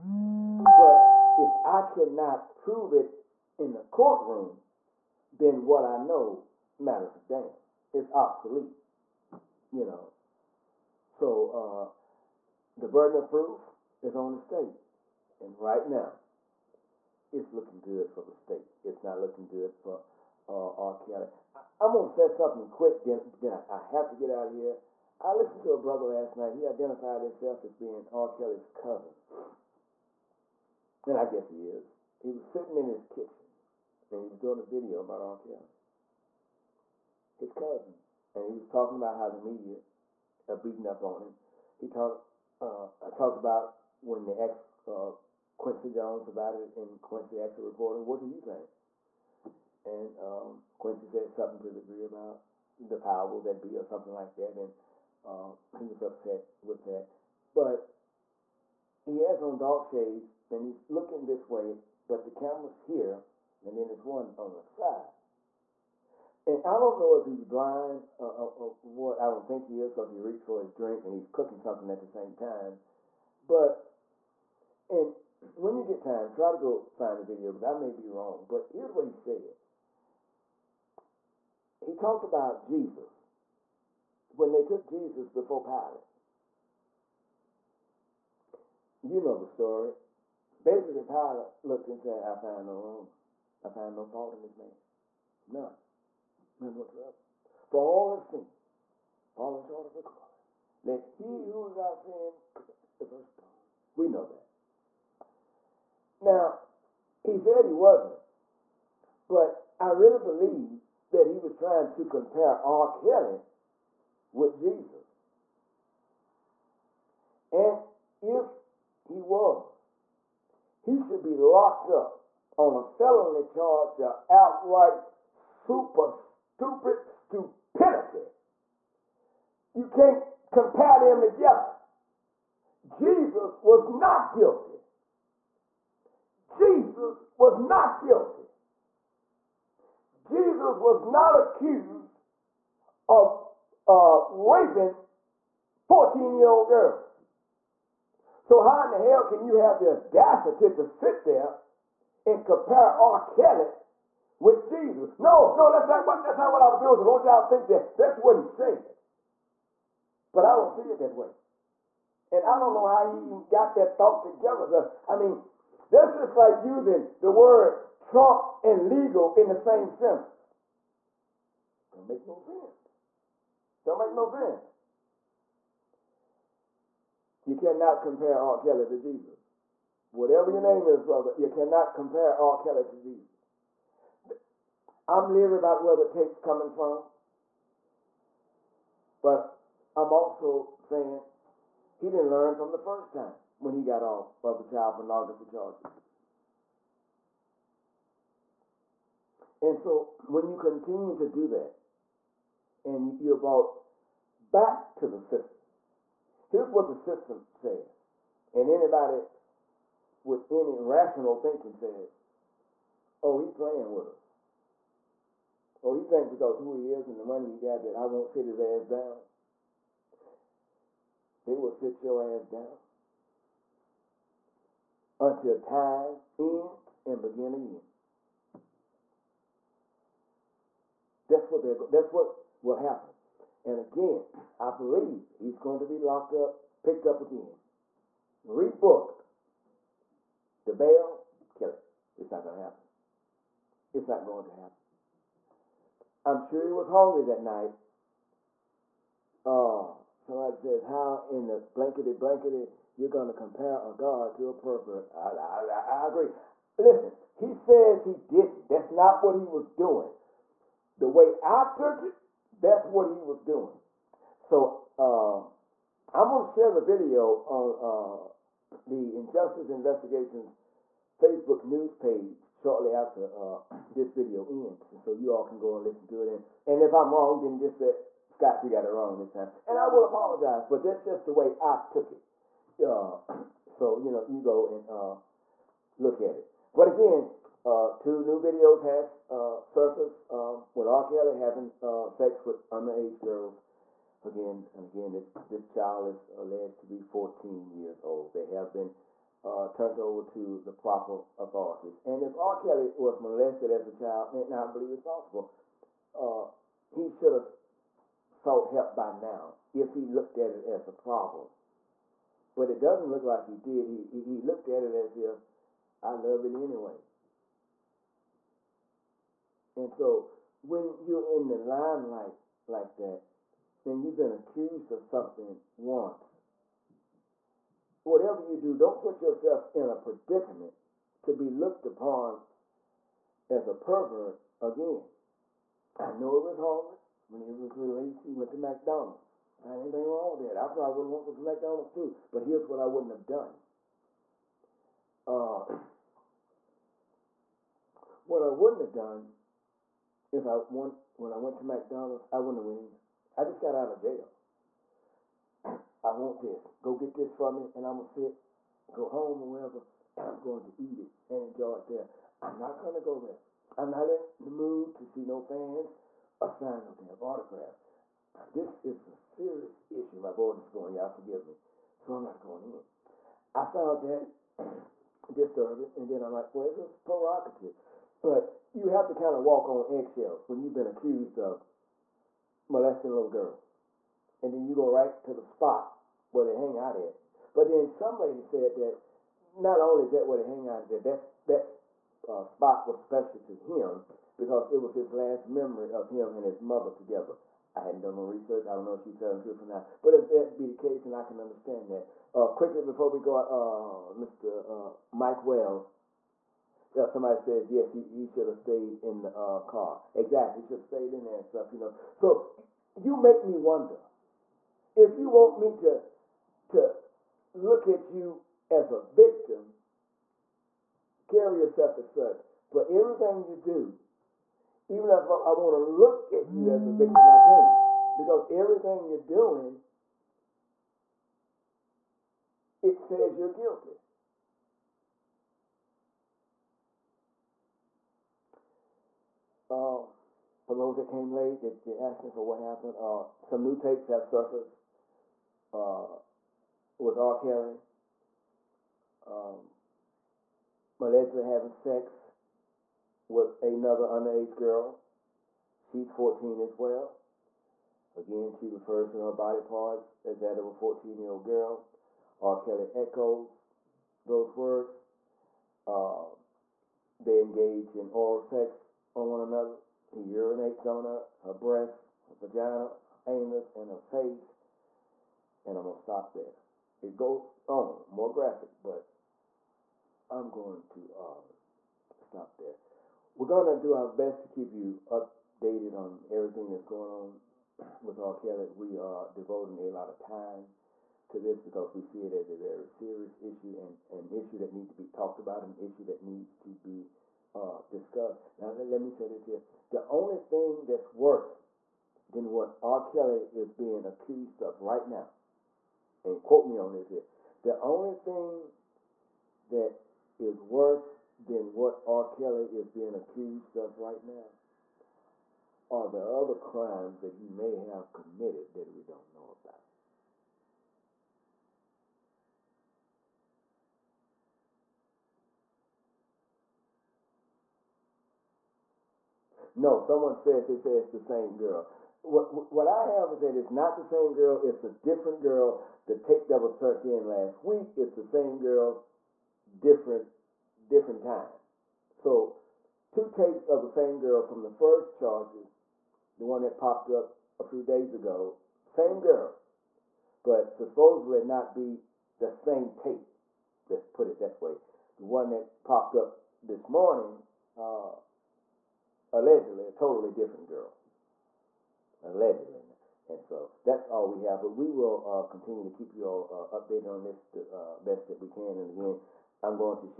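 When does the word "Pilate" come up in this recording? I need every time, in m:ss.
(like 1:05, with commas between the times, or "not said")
1:25, 1:31.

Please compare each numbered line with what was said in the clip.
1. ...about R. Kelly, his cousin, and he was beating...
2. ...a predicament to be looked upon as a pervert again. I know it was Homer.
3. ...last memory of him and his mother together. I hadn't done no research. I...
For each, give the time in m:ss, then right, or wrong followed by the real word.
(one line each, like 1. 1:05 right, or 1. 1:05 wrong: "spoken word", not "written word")
1. 0:35 wrong: "talking", not "beating"
2. 5:29 right
3. 6:35 right.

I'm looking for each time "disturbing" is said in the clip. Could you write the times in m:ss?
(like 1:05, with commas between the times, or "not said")
6:15.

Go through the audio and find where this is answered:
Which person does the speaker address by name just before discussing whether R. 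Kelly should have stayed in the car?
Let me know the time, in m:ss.
6:45.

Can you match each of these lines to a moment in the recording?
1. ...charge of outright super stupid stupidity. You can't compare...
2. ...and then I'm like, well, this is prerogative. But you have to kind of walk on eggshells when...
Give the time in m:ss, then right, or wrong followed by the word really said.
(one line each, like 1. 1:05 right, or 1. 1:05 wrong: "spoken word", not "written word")
1. 2:03 right
2. 6:15 right.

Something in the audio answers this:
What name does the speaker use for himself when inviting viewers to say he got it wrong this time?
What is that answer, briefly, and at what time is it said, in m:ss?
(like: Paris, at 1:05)
Scott, at 4:38.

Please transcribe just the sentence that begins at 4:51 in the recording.
Kelly having uh, sex with underage girls.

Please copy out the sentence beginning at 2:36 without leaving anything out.
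So, don't y'all think that that's what he said.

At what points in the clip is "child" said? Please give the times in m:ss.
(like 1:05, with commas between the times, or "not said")
3:14, 4:55, 5:03.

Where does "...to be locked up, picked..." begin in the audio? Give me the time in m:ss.
3:55.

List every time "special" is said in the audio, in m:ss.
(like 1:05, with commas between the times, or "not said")
6:32.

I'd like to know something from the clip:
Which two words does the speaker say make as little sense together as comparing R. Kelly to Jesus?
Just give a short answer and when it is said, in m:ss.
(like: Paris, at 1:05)
trump and legal, at 2:48.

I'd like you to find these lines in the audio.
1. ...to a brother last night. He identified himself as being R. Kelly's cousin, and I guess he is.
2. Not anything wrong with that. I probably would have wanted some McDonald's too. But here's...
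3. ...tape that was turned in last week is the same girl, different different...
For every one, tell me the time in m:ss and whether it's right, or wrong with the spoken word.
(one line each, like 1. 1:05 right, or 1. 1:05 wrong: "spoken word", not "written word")
1. 0:25 right
2. 5:39 right
3. 8:56 right.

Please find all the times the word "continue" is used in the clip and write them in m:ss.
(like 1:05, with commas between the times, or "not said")
3:20, 9:25.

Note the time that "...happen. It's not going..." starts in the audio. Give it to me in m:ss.
4:02.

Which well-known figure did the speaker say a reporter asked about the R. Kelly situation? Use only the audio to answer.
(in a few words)
Quincy Jones.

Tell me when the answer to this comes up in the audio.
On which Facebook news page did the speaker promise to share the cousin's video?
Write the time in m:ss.
4:29.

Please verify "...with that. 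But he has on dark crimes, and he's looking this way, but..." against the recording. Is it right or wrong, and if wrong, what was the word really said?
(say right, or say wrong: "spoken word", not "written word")
wrong: "shades", not "crimes".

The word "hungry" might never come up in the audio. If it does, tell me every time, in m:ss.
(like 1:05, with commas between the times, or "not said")
4:06.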